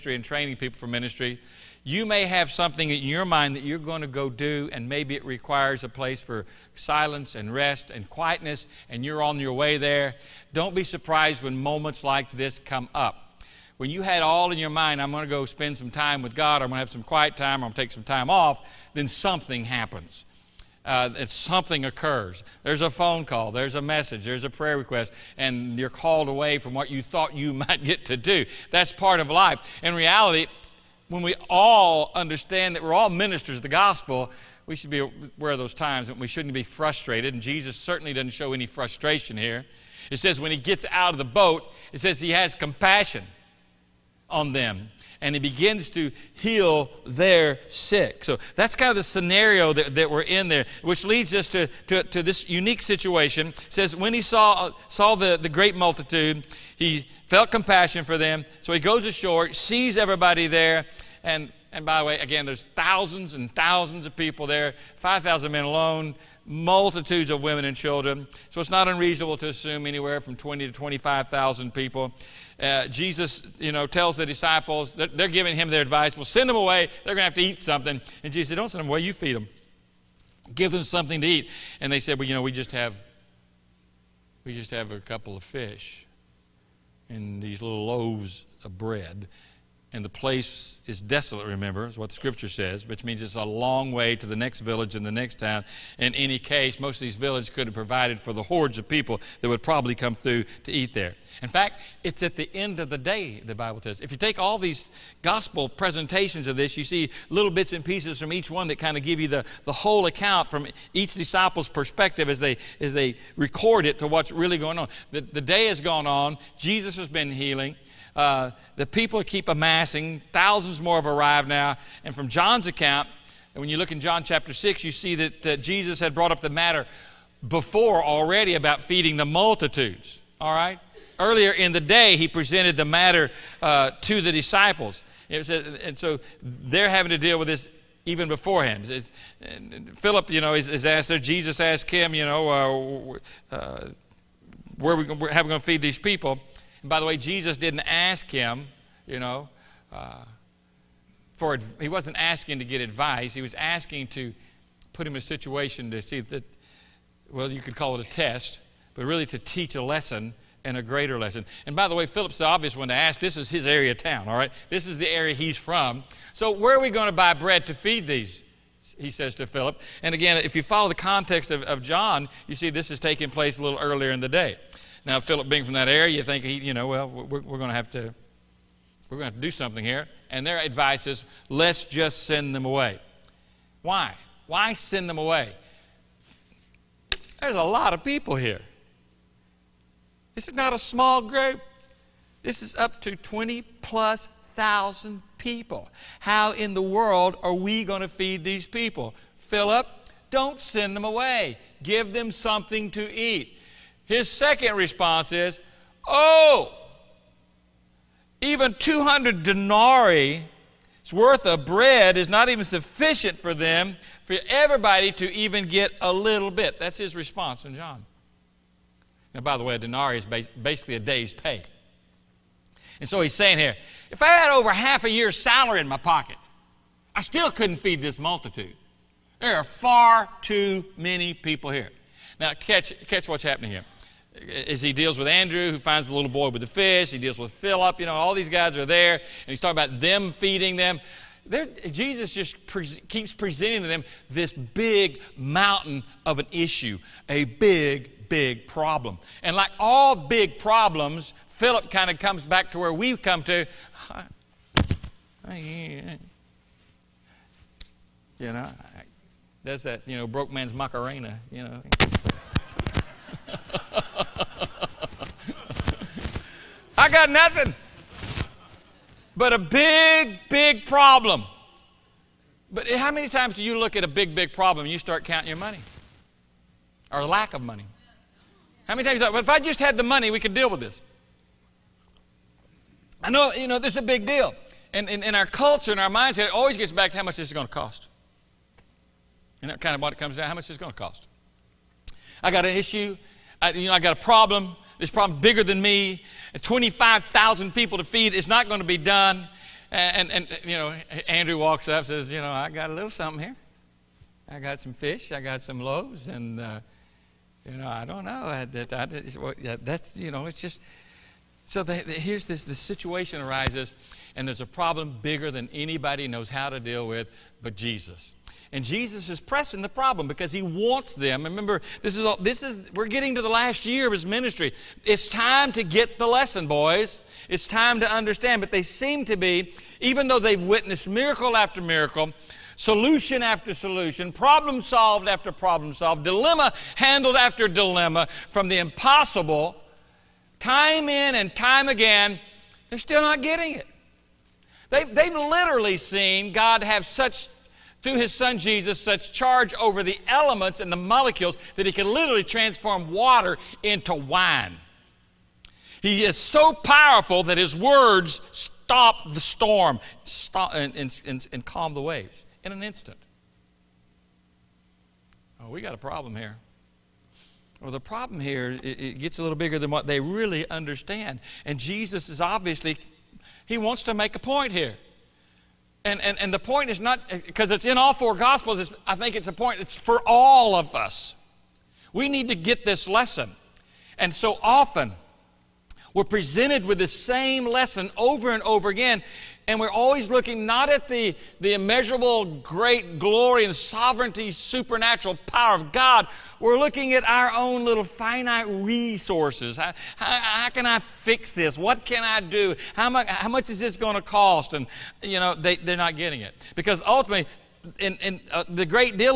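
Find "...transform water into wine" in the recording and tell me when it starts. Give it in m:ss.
5:52.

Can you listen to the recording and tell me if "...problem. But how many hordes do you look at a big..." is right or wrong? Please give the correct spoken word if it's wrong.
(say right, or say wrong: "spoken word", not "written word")
wrong: "times", not "hordes".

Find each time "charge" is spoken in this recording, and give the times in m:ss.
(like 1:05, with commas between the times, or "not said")
5:49.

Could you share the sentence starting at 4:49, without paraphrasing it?
And that kind of what it comes down how much is going to cost.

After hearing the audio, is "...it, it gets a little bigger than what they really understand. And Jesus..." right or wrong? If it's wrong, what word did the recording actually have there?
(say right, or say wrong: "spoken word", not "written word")
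right.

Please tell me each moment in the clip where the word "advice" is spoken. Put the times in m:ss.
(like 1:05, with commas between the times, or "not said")
1:15, 2:32, 3:00.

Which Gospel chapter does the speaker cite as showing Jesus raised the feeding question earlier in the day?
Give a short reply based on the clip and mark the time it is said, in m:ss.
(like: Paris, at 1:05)
John chapter 6, at 2:03.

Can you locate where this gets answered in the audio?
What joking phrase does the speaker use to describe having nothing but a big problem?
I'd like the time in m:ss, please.
4:20.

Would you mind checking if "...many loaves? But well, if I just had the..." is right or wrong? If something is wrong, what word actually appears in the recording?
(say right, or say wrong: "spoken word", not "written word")
wrong: "times", not "loaves".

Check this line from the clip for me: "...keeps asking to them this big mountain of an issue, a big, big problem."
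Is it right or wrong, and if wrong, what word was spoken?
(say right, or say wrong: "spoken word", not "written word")
wrong: "presenting", not "asking".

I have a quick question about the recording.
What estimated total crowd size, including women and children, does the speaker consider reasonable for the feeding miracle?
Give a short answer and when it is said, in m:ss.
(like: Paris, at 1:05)
20 to 25,000, at 1:10.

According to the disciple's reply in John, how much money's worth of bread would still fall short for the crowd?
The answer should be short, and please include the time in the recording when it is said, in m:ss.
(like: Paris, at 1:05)
200 denarii, at 3:28.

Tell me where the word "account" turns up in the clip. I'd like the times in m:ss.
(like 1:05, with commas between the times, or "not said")
1:50, 2:02.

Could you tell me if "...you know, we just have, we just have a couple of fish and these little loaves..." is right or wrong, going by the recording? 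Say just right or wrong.
right.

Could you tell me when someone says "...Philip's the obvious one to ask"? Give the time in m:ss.
2:42.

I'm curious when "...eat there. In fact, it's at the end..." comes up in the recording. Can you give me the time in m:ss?
1:40.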